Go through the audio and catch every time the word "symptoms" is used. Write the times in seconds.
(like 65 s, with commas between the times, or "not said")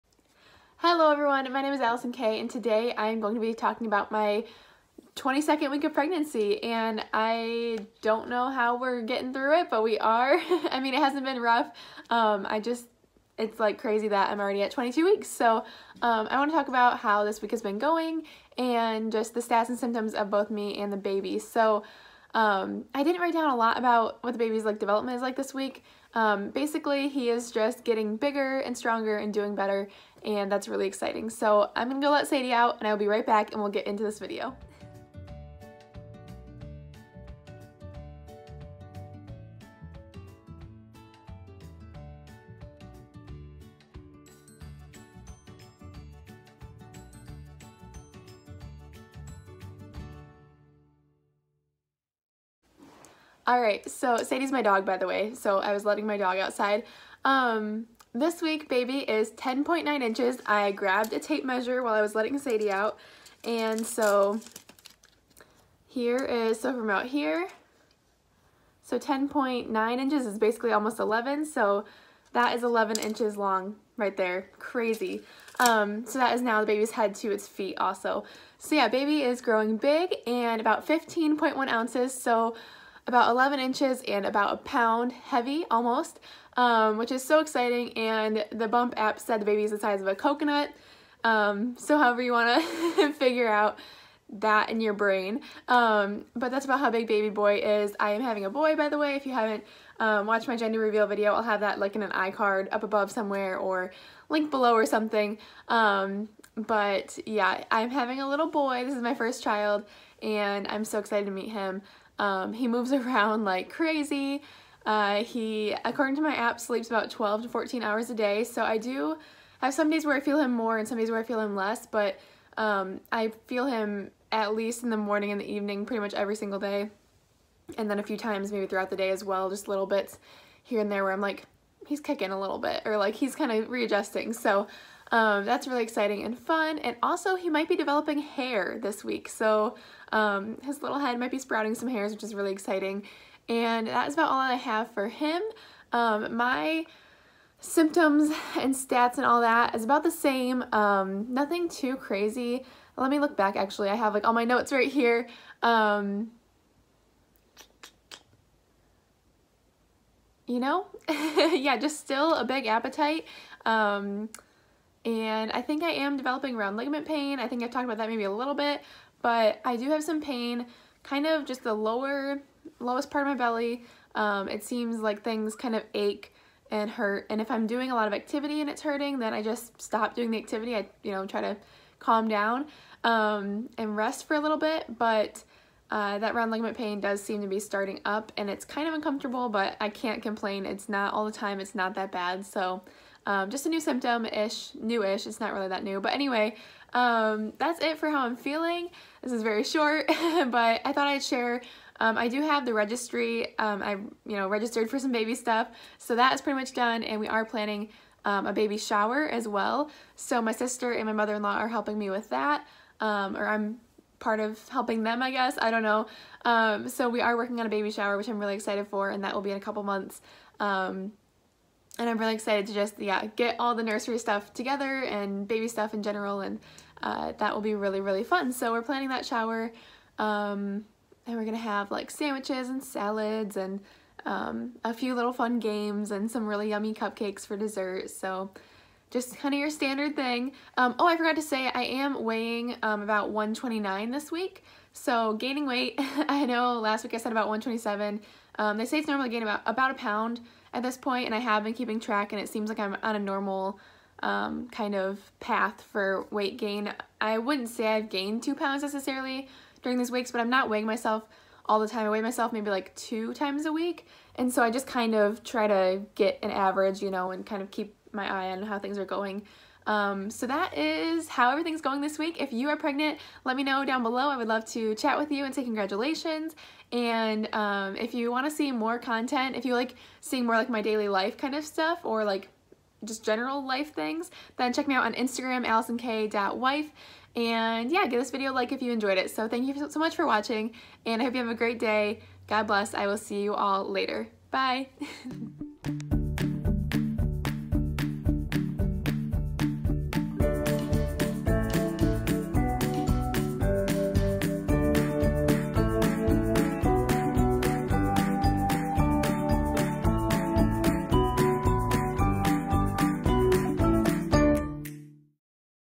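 19 s, 147 s, 193 s.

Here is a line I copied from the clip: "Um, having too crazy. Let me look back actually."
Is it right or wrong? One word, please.
wrong.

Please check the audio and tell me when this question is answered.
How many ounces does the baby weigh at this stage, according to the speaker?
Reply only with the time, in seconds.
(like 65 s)
80 s.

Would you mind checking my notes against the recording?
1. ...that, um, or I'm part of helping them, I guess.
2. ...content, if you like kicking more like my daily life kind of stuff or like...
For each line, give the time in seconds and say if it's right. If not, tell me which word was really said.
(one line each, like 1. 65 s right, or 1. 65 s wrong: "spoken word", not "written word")
1. 212 s right
2. 278 s wrong: "seeing", not "kicking".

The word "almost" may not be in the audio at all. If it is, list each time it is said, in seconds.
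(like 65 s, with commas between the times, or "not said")
70 s, 85 s.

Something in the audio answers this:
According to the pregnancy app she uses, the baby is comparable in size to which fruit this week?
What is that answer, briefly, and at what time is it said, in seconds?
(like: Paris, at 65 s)
coconut, at 90 s.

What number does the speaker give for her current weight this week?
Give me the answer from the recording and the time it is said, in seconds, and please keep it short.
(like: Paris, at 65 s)
129, at 243 s.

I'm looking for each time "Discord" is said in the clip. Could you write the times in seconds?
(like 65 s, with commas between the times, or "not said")
not said.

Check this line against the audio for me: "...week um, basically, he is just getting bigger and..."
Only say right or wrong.
right.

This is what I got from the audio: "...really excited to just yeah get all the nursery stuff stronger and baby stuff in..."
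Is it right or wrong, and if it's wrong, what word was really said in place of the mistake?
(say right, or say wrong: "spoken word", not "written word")
wrong: "together", not "stronger".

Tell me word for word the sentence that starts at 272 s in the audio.
If you are pregnant, let me know down below.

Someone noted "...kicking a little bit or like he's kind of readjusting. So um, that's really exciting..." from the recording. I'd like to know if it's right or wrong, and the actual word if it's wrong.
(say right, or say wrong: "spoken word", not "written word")
right.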